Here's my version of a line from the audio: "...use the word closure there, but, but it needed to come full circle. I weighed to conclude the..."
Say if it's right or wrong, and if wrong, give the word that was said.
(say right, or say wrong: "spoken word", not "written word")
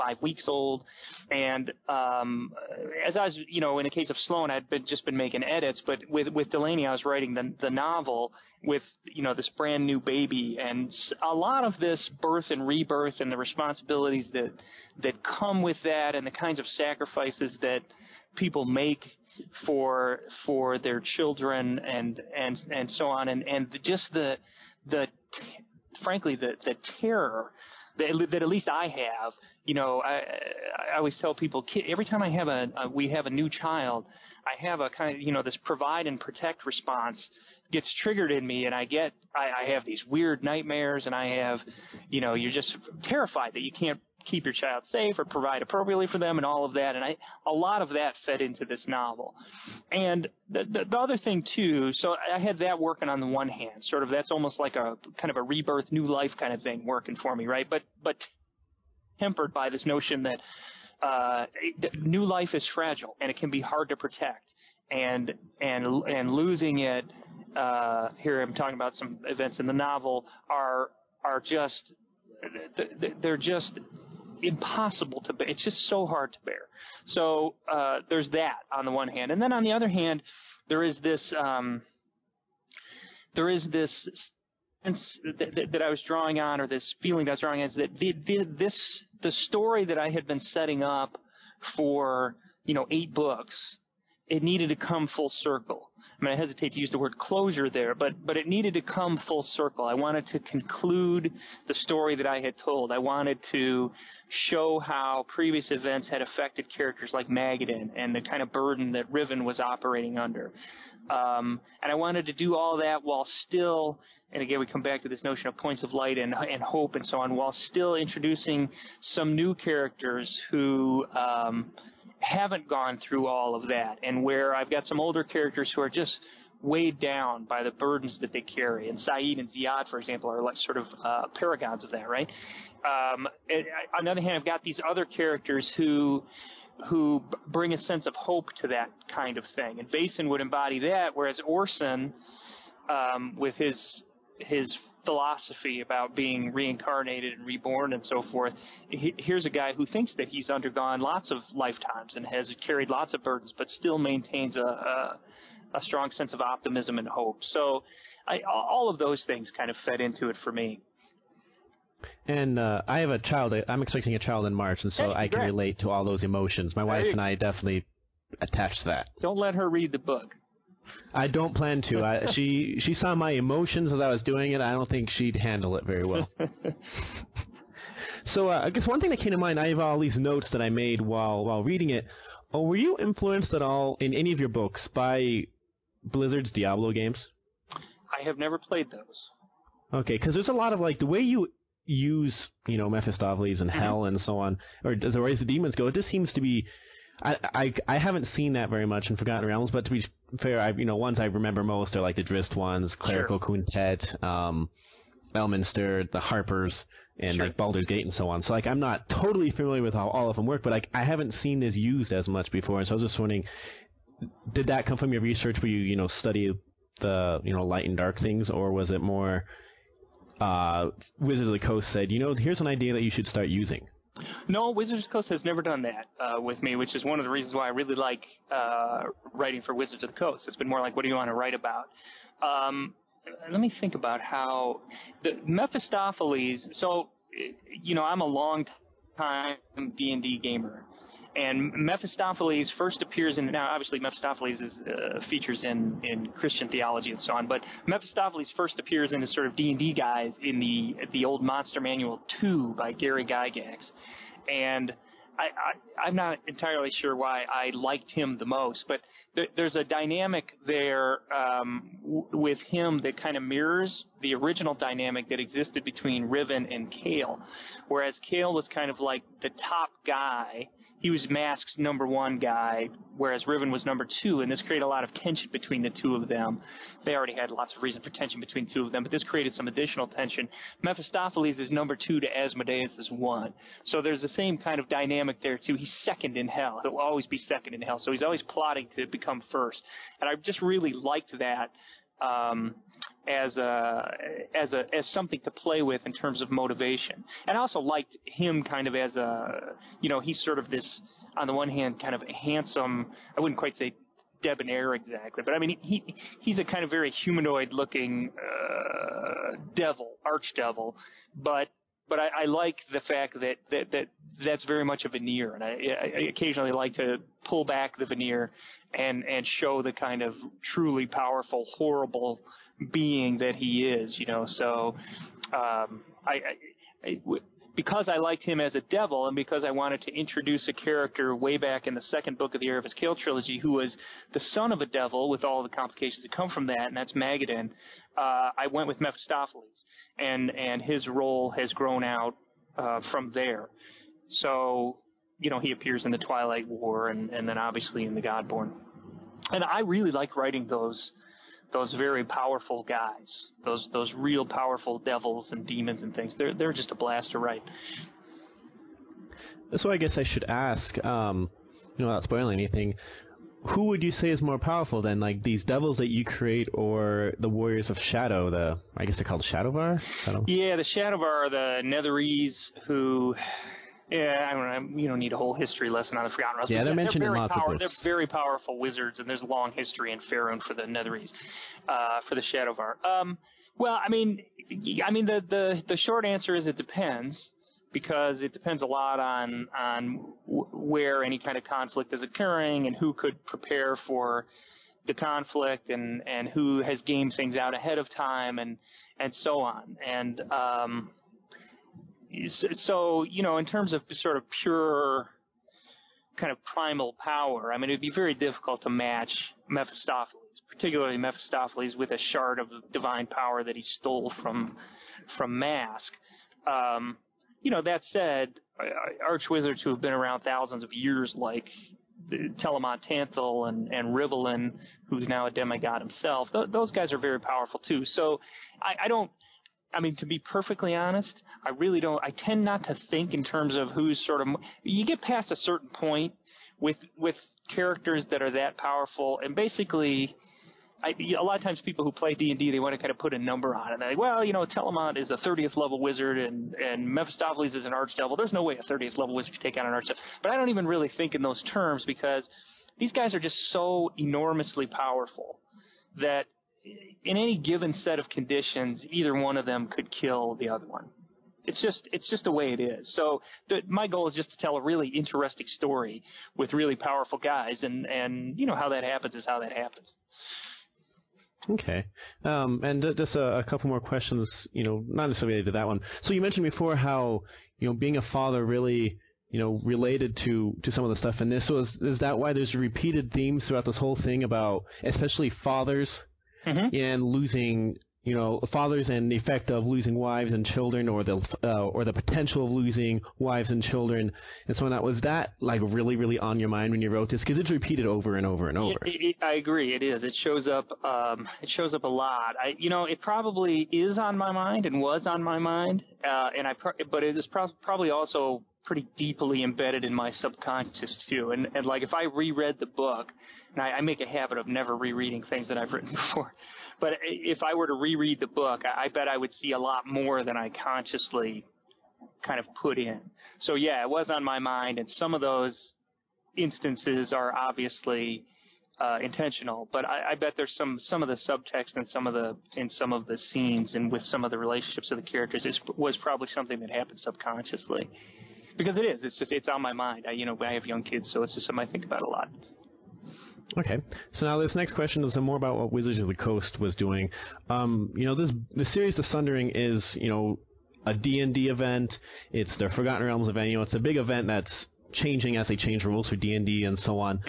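wrong: "wanted", not "weighed".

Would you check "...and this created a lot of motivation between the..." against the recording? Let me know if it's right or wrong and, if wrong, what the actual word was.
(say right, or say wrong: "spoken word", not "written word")
wrong: "tension", not "motivation".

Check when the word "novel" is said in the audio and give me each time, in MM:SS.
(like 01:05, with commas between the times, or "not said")
00:07, 00:48, 01:09.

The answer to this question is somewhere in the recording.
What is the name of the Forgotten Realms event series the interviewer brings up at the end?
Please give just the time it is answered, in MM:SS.
09:09.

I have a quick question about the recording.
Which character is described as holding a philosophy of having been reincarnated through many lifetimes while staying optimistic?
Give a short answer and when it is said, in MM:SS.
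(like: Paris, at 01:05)
Orsin, at 02:21.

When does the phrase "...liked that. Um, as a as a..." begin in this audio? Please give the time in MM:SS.
04:50.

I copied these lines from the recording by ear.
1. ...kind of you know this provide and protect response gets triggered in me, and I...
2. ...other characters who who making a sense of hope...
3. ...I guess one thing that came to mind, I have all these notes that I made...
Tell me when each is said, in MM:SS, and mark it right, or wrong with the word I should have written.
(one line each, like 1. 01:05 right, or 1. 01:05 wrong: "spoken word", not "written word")
1. 00:34 right
2. 02:14 wrong: "bring", not "making"
3. 02:58 right.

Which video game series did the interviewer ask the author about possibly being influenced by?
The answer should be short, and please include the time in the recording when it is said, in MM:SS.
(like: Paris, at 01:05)
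Diablo, at 03:06.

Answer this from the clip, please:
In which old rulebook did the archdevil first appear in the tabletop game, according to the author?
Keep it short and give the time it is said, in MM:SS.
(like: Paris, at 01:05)
Monster Manual 2, at 04:11.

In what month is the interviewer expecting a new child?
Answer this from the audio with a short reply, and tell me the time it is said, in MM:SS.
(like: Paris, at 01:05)
March, at 02:44.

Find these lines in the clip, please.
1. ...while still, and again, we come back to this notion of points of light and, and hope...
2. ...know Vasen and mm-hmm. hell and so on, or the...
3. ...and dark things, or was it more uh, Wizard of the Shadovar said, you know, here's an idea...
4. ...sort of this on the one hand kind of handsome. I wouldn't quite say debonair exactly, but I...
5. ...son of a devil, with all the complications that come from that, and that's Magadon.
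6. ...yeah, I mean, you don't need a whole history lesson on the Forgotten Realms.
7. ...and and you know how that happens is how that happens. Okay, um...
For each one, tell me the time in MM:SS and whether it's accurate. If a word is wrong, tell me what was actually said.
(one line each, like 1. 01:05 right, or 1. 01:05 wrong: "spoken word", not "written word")
1. 01:53 right
2. 03:12 wrong: "Mephistopheles", not "Vasen"
3. 03:37 wrong: "Coast", not "Shadovar"
4. 05:00 right
5. 05:34 right
6. 06:14 right
7. 07:47 right.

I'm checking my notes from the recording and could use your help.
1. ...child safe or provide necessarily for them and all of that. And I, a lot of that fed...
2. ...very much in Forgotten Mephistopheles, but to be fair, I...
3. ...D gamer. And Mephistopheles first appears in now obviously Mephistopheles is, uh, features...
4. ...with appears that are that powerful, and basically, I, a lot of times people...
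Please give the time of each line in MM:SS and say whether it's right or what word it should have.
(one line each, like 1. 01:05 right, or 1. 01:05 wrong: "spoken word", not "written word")
1. 00:44 wrong: "appropriately", not "necessarily"
2. 03:18 wrong: "Realms", not "Mephistopheles"
3. 04:00 right
4. 07:17 wrong: "characters", not "appears".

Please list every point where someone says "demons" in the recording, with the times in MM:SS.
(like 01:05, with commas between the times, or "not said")
03:15, 05:55.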